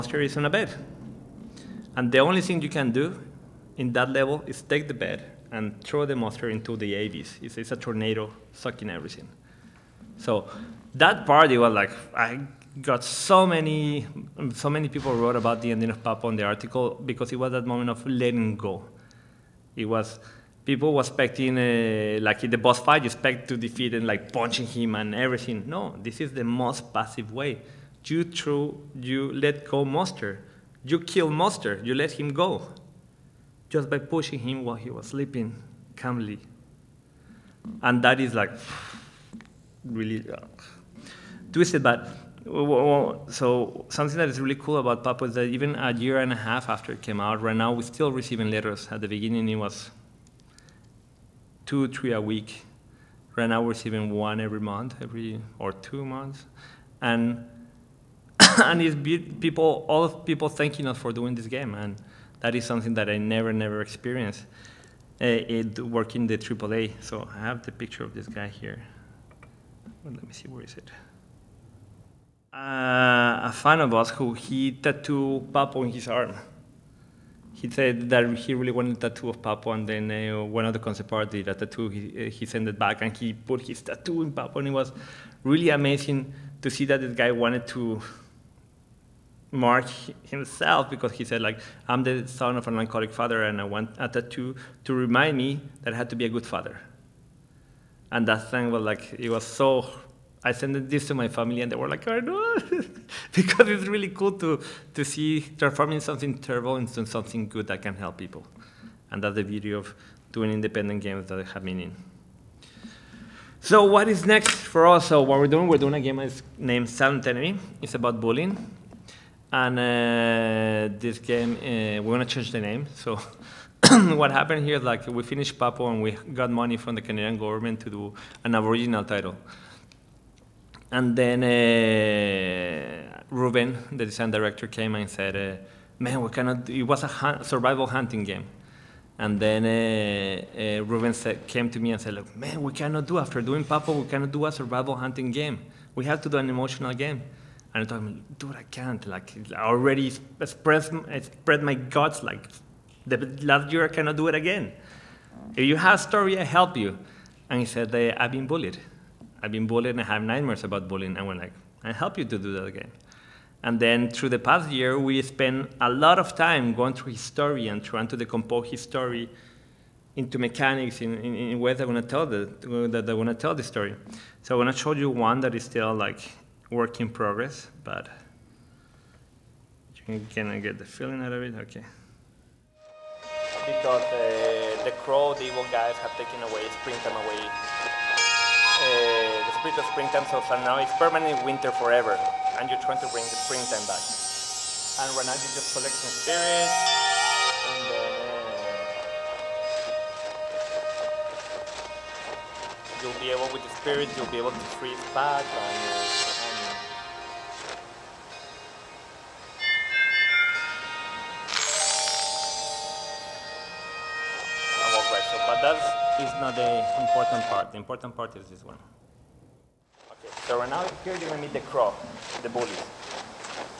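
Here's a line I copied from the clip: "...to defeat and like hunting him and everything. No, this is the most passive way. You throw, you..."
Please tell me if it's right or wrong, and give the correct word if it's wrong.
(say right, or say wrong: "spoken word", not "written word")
wrong: "punching", not "hunting".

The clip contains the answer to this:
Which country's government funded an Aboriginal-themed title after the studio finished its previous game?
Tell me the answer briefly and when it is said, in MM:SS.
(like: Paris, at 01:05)
Canadian, at 02:07.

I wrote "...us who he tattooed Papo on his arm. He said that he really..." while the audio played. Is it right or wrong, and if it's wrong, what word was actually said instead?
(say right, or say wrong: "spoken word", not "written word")
right.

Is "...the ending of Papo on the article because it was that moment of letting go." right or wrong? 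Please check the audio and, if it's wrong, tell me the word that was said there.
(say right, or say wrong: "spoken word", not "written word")
right.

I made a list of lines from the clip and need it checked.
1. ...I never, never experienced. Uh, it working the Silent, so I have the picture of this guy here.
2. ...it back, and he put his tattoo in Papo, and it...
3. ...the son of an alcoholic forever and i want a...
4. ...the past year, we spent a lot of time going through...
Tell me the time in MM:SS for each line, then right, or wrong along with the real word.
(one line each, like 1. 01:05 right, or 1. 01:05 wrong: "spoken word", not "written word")
1. 01:03 wrong: "AAA", not "Silent"
2. 01:22 right
3. 01:32 wrong: "father", not "forever"
4. 02:44 right.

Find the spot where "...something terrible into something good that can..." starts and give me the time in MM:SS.
01:45.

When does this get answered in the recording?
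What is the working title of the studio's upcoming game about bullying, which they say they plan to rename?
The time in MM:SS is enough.
01:56.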